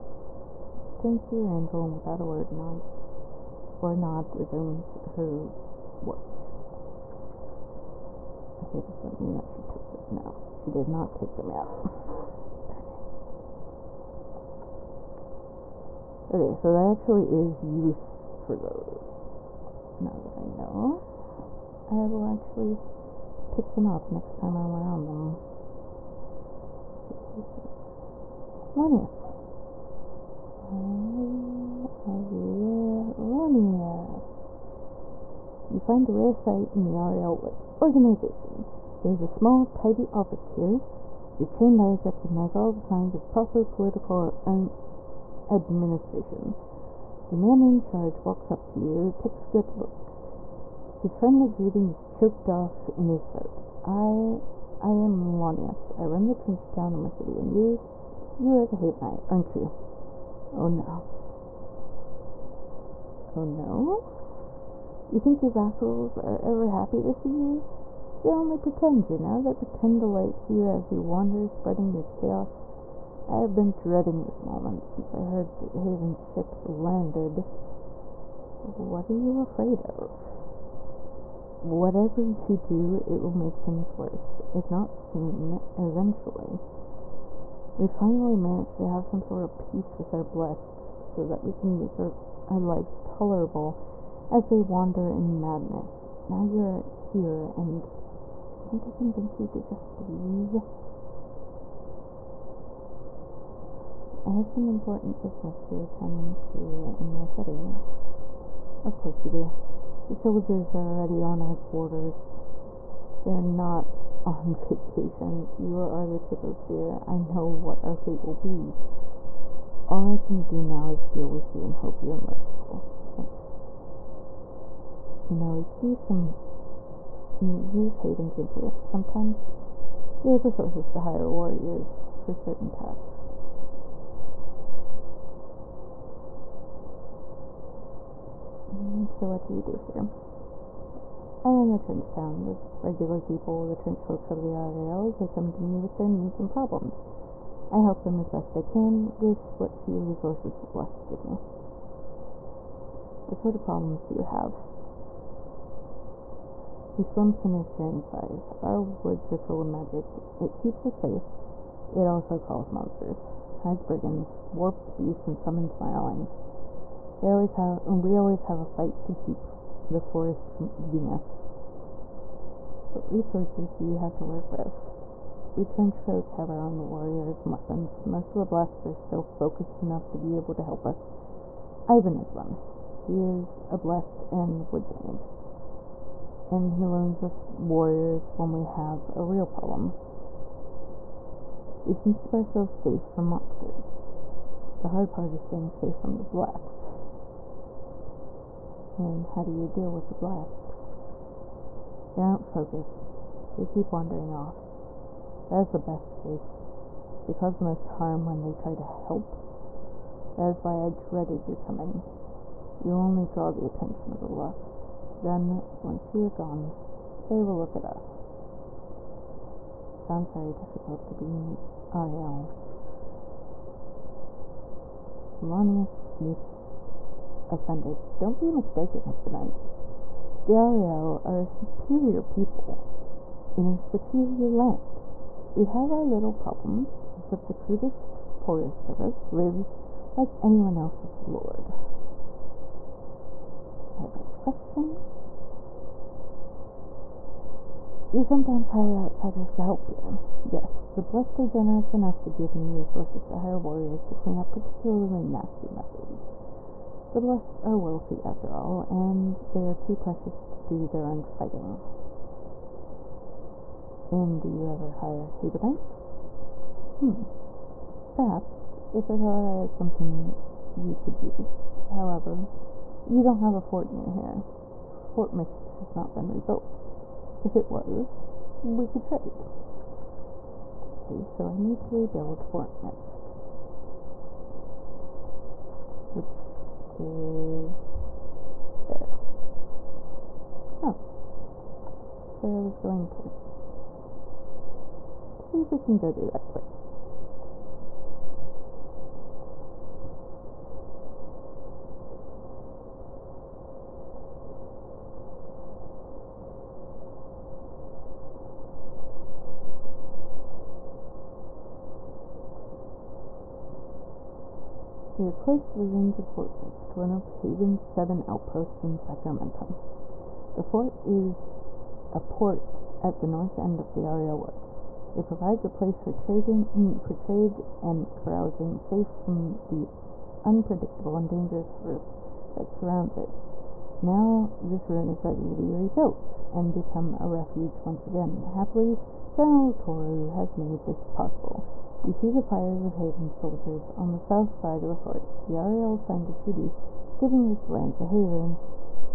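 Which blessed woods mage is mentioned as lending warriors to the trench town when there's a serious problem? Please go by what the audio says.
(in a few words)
Ivan.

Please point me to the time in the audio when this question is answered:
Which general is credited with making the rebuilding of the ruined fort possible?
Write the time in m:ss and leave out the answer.
5:39.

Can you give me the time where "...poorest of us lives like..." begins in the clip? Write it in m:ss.
3:58.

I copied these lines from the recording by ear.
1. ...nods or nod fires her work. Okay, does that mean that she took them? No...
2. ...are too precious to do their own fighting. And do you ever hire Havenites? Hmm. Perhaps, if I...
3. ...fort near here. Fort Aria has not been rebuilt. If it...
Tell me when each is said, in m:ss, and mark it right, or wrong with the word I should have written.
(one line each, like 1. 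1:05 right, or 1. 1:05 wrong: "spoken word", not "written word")
1. 0:02 wrong: "resumes", not "fires"
2. 4:19 right
3. 4:33 wrong: "Mist", not "Aria".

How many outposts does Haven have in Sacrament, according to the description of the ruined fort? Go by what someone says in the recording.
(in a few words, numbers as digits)
7.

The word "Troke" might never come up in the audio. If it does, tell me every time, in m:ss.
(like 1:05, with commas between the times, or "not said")
2:55.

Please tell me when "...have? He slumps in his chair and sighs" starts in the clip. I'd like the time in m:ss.
2:34.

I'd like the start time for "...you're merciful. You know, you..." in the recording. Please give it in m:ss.
2:02.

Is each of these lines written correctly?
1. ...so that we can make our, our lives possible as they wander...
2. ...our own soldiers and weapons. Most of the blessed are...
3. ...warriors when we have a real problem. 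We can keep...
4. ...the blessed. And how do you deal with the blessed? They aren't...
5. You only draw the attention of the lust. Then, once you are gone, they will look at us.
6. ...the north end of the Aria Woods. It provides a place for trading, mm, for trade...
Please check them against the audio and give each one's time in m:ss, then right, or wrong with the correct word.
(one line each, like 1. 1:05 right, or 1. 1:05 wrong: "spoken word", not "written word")
1. 1:31 wrong: "tolerable", not "possible"
2. 2:56 wrong: "warriors", not "soldiers"
3. 3:07 right
4. 3:16 right
5. 3:32 right
6. 5:23 right.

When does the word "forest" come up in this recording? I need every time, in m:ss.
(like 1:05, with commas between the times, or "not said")
2:49, 5:31.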